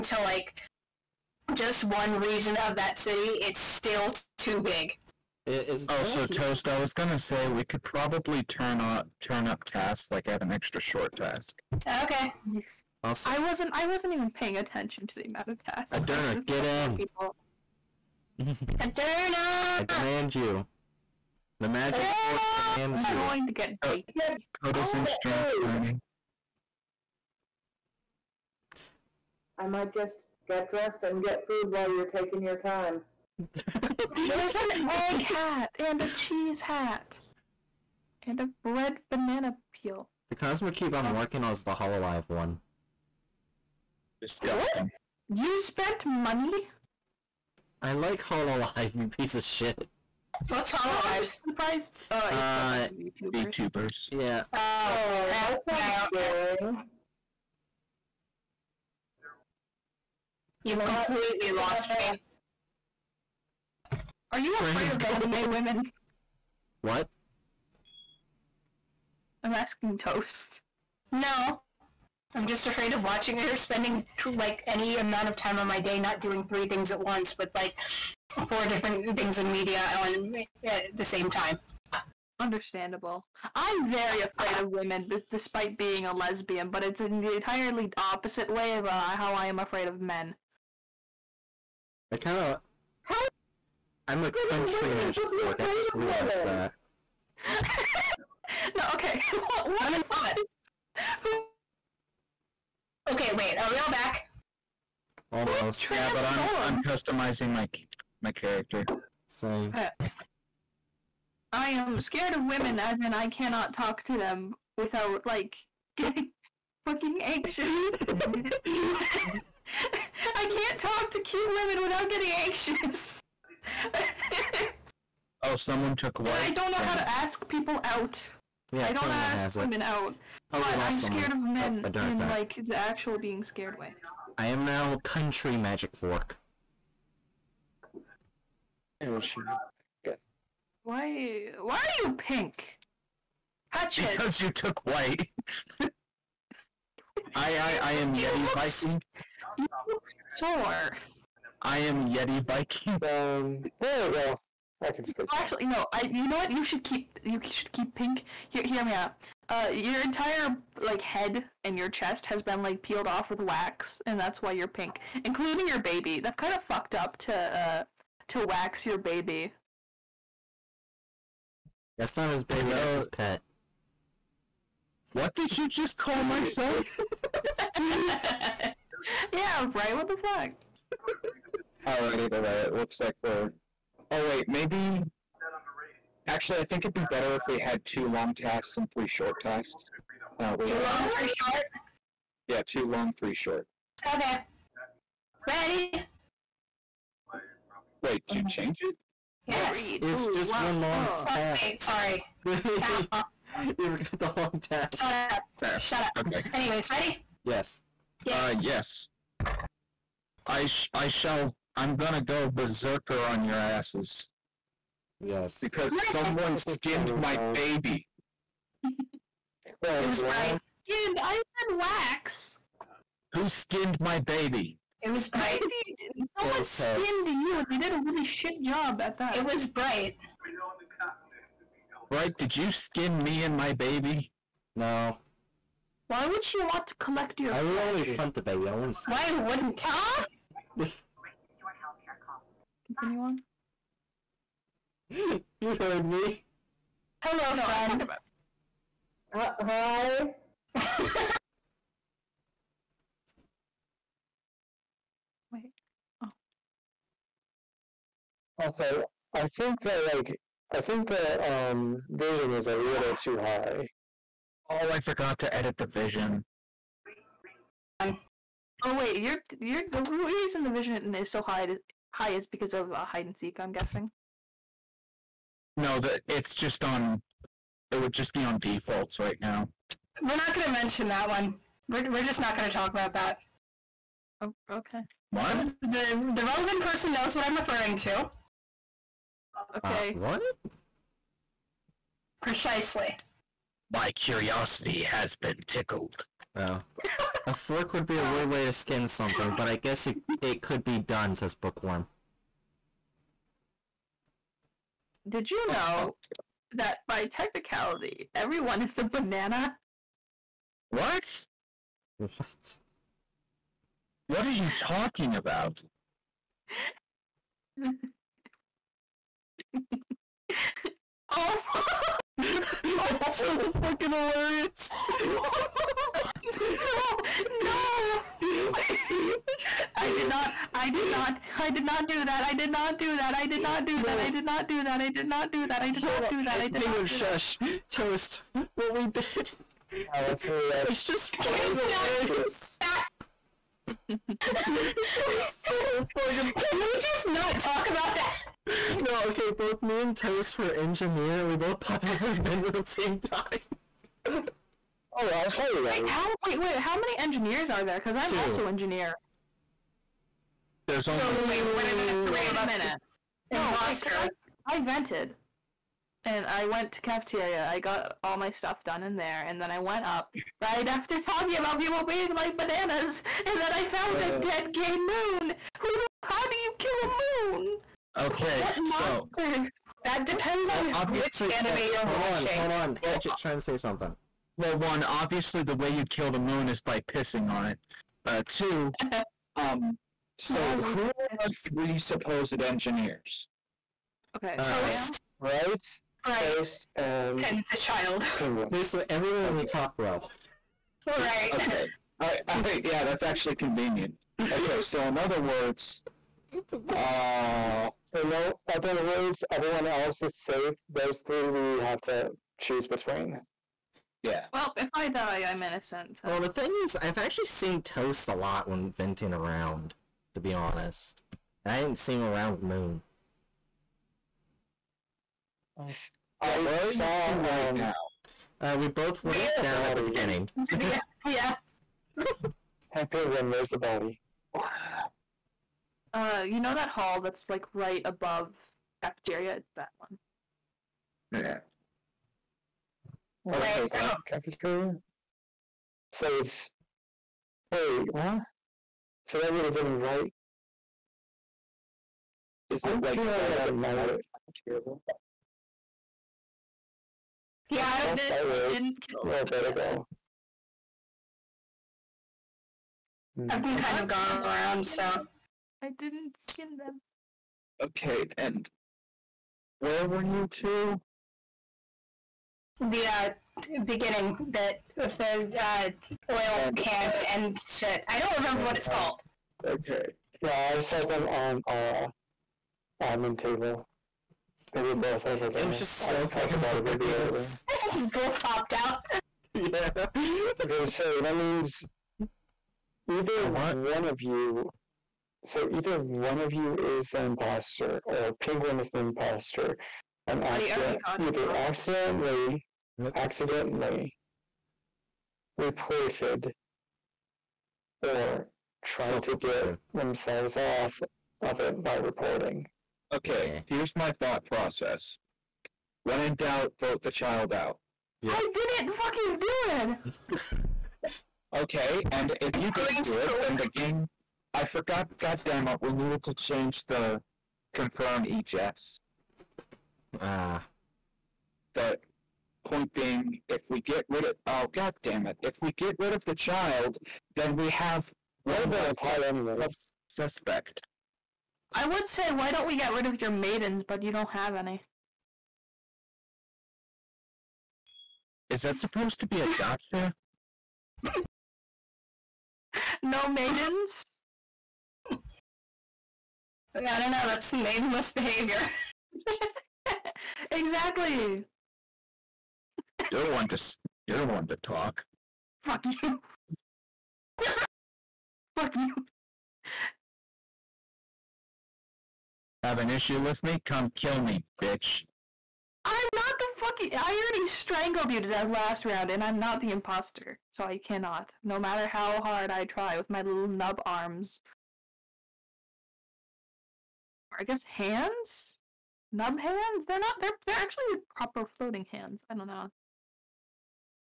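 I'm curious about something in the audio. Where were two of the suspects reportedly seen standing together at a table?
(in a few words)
admin.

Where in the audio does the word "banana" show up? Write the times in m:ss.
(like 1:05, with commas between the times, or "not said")
0:39, 5:09, 6:12.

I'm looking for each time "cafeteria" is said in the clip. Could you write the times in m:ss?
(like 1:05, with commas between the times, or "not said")
6:07, 7:19, 7:24.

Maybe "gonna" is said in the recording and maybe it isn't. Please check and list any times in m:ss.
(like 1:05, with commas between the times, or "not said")
0:06, 3:31.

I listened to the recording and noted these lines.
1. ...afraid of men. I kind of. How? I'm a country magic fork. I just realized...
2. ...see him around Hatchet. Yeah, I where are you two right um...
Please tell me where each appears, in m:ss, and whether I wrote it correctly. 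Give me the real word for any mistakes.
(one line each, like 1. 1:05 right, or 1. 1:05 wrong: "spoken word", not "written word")
1. 1:29 right
2. 7:01 wrong: "Moon", not "Hatchet".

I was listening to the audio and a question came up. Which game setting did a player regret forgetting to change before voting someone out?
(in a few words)
confirm ejects.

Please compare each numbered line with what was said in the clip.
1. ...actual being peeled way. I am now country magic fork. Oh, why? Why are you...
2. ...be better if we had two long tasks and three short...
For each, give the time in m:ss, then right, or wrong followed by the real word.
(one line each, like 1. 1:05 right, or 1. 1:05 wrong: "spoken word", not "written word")
1. 2:12 wrong: "scared", not "peeled"
2. 3:06 right.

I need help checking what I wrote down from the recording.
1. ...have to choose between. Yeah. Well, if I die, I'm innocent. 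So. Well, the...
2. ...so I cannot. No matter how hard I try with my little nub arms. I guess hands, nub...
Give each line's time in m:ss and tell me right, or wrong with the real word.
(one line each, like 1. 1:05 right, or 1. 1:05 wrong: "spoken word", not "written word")
1. 6:51 right
2. 9:40 right.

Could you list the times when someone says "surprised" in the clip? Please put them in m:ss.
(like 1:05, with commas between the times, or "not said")
0:51.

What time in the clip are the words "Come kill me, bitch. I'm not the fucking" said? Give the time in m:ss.
9:33.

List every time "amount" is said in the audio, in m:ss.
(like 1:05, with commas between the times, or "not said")
0:15, 1:14.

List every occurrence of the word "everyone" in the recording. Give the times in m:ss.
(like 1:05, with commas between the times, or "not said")
5:08, 6:39, 6:49.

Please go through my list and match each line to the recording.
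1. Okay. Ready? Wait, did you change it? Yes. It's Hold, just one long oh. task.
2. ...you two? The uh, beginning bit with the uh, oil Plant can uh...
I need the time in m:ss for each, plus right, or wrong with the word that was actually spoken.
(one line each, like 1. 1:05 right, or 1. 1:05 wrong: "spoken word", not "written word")
1. 3:14 wrong: "Ooh", not "Hold"
2. 7:50 right.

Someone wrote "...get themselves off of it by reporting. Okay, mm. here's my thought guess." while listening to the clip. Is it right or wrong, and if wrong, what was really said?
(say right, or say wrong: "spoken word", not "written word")
wrong: "process", not "guess".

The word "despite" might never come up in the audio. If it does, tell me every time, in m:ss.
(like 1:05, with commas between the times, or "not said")
1:25.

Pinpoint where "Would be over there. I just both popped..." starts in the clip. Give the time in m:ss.
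8:06.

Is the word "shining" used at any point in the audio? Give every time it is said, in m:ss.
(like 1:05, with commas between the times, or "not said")
0:25.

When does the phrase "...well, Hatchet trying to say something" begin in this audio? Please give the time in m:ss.
6:23.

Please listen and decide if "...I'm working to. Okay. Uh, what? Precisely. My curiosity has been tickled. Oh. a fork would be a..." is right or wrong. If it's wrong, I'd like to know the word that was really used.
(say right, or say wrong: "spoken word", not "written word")
wrong: "referring", not "working".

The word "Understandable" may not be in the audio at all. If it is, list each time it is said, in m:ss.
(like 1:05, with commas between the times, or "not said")
1:22.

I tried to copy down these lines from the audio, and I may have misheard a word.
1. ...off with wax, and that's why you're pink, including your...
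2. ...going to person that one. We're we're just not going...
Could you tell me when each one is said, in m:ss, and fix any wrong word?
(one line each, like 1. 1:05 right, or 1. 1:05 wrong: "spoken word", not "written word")
1. 2:43 right
2. 4:40 wrong: "mention", not "person".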